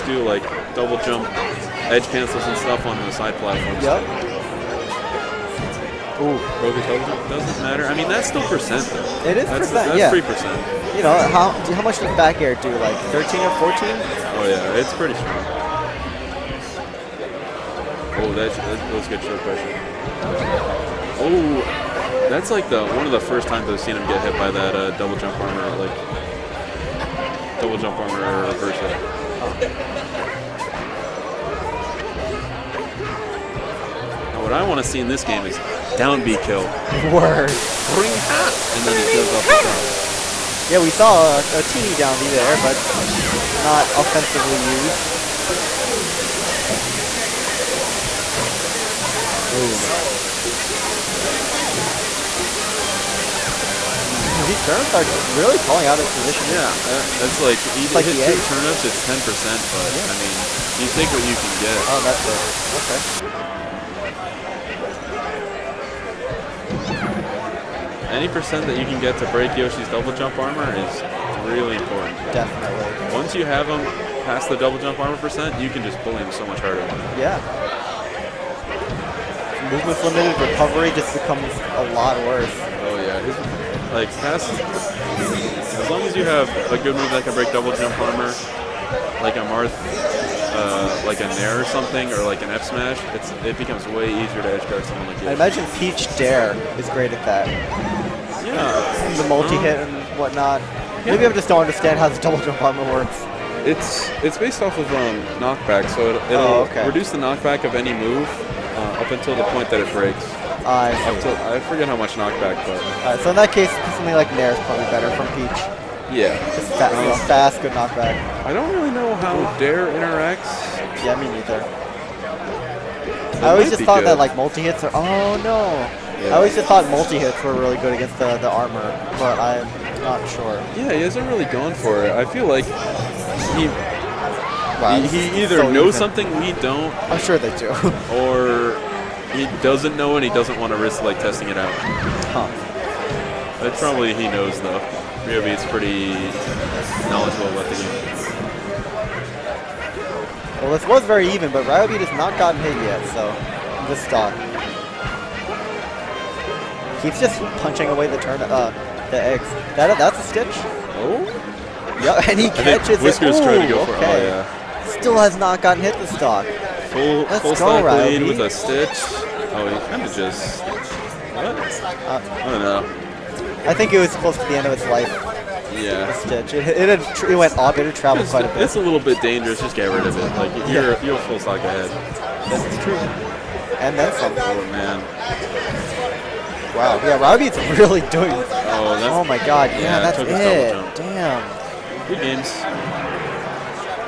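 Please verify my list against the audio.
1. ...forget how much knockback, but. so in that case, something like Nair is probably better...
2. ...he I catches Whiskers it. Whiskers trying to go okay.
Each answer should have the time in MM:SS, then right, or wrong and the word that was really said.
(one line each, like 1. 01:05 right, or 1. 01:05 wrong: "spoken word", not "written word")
1. 01:51 right
2. 02:42 right.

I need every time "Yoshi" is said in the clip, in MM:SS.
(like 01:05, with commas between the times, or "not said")
01:09.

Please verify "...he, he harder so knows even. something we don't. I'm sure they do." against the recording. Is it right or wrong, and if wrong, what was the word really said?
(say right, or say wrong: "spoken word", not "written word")
wrong: "either", not "harder".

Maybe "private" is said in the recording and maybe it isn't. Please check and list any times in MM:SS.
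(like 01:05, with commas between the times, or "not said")
not said.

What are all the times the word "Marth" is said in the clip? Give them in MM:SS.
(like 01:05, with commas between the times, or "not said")
01:29.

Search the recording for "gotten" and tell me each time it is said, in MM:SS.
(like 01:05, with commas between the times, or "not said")
02:32, 02:45.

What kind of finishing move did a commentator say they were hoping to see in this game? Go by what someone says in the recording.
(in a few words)
down B kill.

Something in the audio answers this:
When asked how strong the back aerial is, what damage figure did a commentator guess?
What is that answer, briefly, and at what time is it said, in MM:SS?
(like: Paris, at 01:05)
13 or 14, at 00:13.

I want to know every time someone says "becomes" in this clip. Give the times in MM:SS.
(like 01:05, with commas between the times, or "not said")
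01:21, 01:33.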